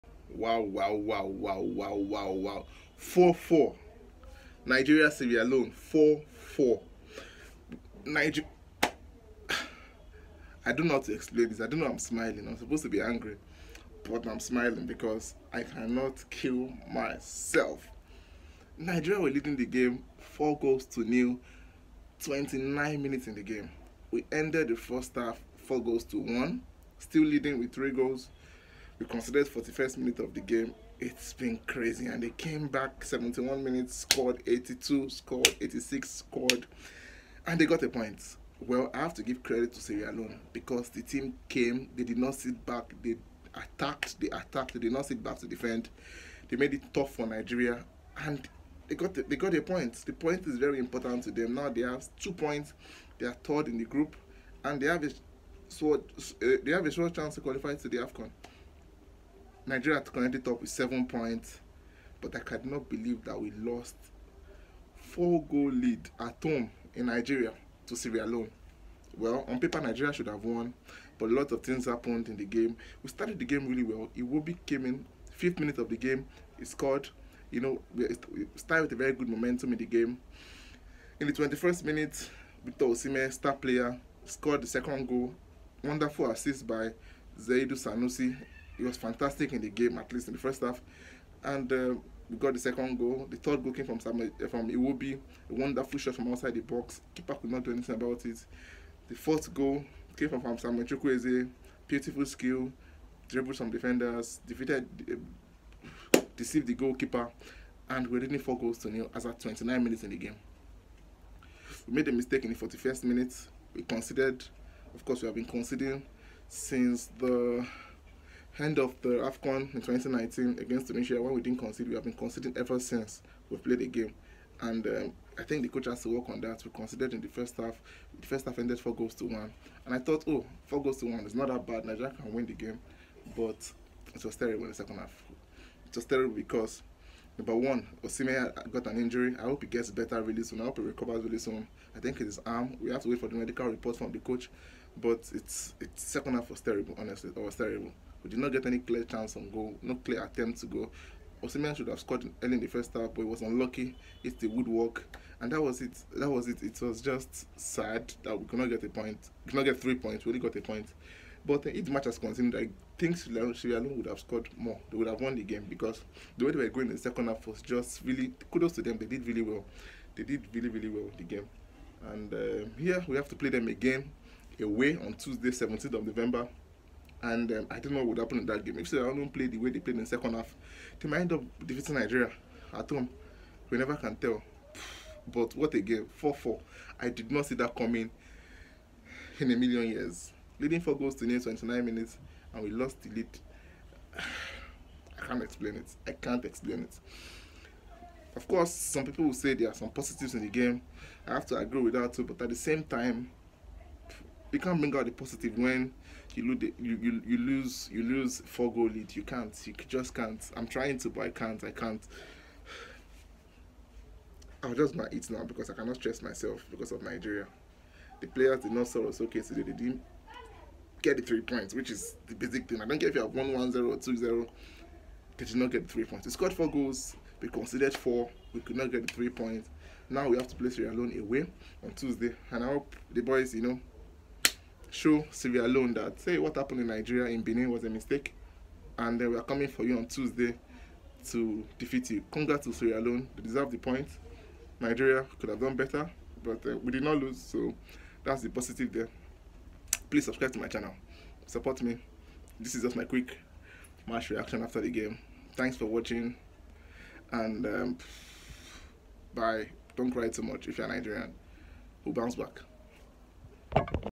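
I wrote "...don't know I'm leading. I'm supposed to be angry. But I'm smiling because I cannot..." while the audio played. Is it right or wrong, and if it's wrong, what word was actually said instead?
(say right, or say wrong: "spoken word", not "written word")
wrong: "smiling", not "leading".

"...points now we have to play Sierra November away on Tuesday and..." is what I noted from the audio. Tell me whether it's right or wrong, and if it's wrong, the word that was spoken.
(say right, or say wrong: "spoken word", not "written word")
wrong: "Leone", not "November".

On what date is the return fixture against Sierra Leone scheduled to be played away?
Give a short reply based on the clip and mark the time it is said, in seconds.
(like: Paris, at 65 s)
Tuesday, 17th of November, at 175 s.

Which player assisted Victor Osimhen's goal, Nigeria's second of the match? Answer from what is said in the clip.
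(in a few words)
Zaidu Sanusi.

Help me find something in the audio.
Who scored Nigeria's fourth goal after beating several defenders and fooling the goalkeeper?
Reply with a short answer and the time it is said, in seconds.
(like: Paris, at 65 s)
Samuel Chukwueze, at 100 s.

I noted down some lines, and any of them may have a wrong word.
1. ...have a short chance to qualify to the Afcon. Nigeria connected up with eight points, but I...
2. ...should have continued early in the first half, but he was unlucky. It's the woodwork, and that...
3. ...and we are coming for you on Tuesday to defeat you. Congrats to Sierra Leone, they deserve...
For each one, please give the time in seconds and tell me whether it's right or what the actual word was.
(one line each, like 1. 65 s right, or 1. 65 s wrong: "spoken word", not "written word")
1. 56 s wrong: "seven", not "eight"
2. 151 s wrong: "scored", not "continued"
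3. 238 s right.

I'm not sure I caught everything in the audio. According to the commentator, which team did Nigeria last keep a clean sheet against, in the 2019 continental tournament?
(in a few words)
Tunisia.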